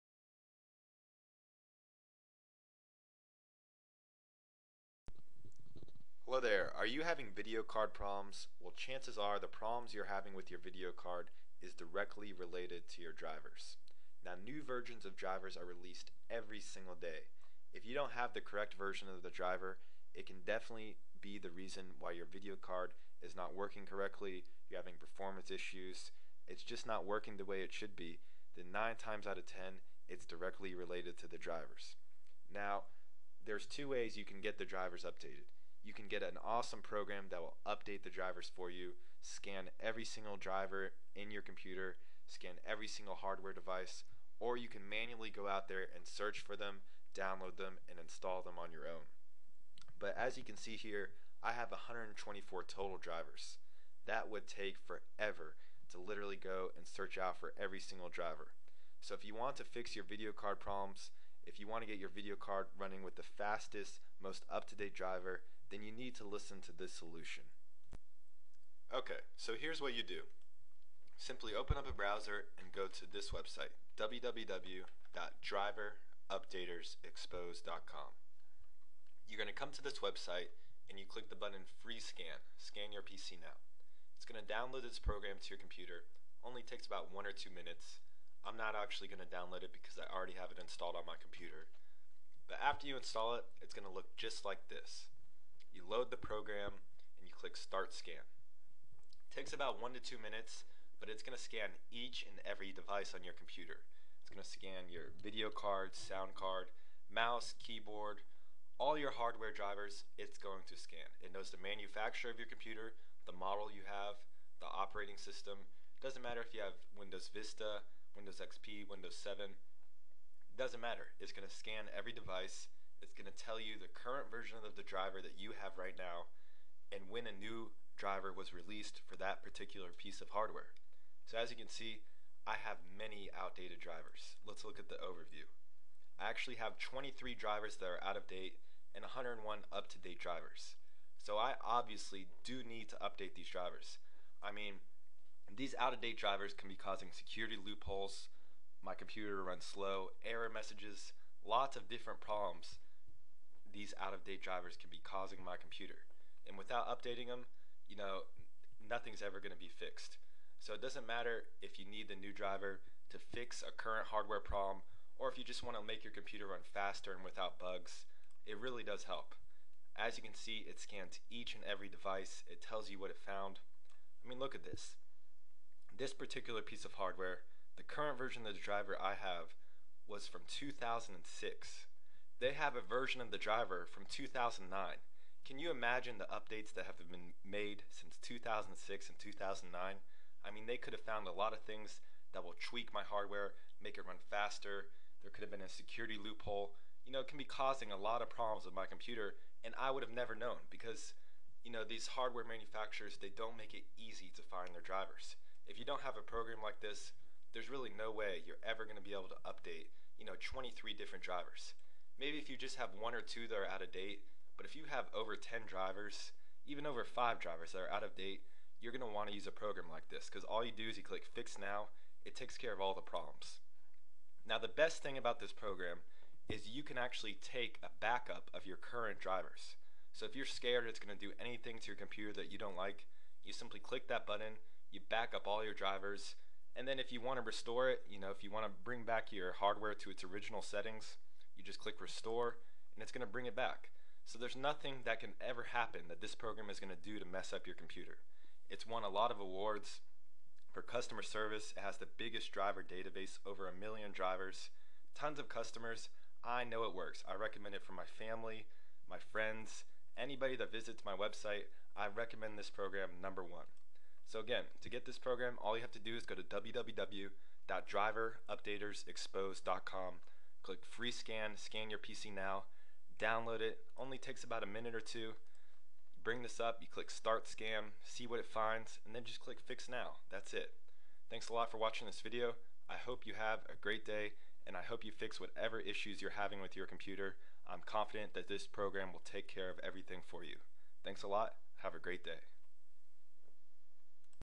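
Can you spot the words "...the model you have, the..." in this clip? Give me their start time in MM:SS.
01:53.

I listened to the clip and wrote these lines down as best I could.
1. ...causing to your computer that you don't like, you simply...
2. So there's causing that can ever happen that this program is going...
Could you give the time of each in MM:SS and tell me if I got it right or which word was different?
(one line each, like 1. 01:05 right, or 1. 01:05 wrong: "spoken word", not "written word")
1. 03:51 wrong: "anything", not "causing"
2. 04:04 wrong: "nothing", not "causing".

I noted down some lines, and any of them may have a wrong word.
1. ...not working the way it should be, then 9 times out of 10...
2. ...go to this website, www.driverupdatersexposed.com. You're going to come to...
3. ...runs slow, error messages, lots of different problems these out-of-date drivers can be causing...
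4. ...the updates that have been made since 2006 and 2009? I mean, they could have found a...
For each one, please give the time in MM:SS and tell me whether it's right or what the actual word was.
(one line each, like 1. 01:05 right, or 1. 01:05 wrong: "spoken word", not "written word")
1. 00:26 right
2. 01:12 right
3. 02:29 right
4. 03:06 right.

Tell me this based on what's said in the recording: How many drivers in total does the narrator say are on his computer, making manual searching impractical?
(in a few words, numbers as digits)
124.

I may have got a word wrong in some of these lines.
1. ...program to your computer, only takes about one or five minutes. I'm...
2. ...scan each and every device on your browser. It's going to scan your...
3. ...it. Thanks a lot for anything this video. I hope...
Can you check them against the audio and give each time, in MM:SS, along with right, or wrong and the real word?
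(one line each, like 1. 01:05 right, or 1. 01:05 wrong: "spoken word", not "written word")
1. 01:24 wrong: "two", not "five"
2. 01:41 wrong: "computer", not "browser"
3. 04:40 wrong: "watching", not "anything".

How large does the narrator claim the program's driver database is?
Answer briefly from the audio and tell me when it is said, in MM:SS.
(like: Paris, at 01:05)
over a million drivers, at 04:13.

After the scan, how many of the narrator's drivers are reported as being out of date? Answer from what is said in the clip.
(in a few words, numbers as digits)
23.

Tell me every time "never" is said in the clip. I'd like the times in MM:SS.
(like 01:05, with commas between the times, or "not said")
03:20.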